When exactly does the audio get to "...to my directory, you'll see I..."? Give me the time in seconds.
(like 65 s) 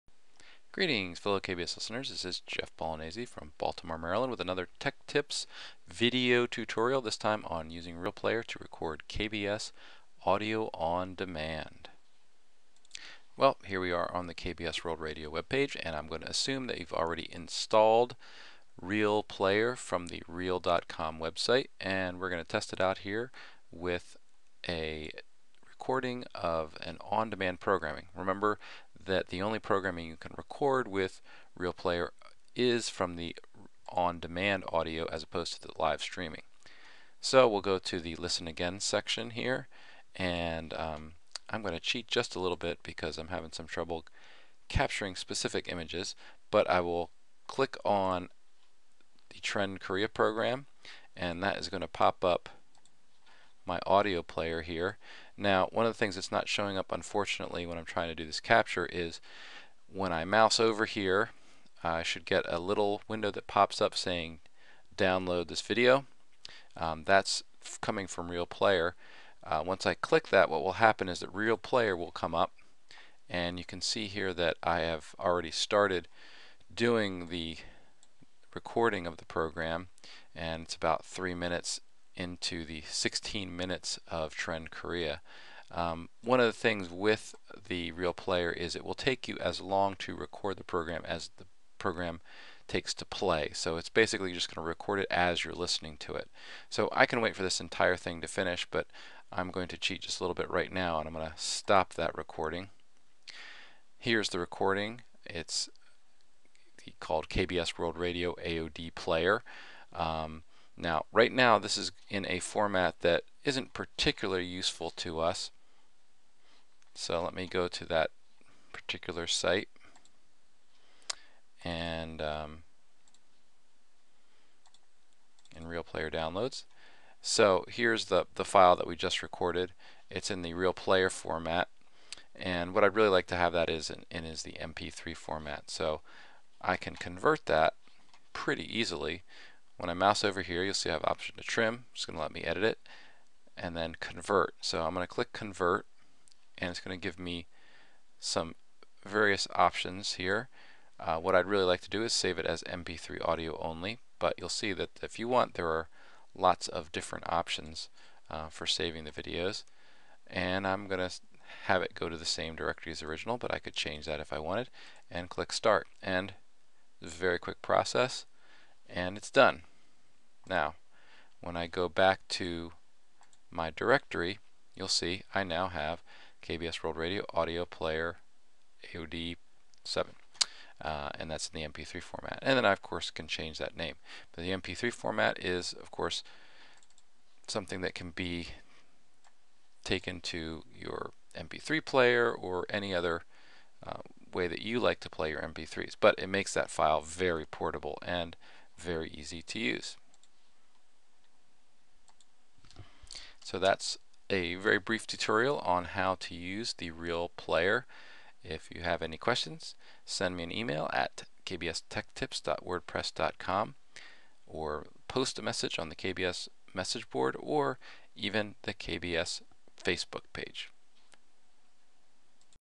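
172 s.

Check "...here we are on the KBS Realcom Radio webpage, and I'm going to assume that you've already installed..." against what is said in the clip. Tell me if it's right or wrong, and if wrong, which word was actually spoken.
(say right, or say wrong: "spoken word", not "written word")
wrong: "World", not "Realcom".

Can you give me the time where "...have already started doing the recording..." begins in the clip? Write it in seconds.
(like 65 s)
74 s.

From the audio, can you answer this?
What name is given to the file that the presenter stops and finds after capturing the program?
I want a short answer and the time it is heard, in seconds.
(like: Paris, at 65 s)
KBS World Radio AOD Player, at 107 s.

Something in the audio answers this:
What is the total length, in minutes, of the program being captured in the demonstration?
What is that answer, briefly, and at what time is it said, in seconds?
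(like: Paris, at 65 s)
16, at 82 s.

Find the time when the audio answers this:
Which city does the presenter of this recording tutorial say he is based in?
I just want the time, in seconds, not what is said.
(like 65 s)
3 s.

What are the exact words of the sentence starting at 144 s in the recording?
So I'm going to click convert and it's going to give me some various options here.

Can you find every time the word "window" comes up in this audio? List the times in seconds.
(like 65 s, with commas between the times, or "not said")
63 s.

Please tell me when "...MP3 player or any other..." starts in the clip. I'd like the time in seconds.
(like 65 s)
191 s.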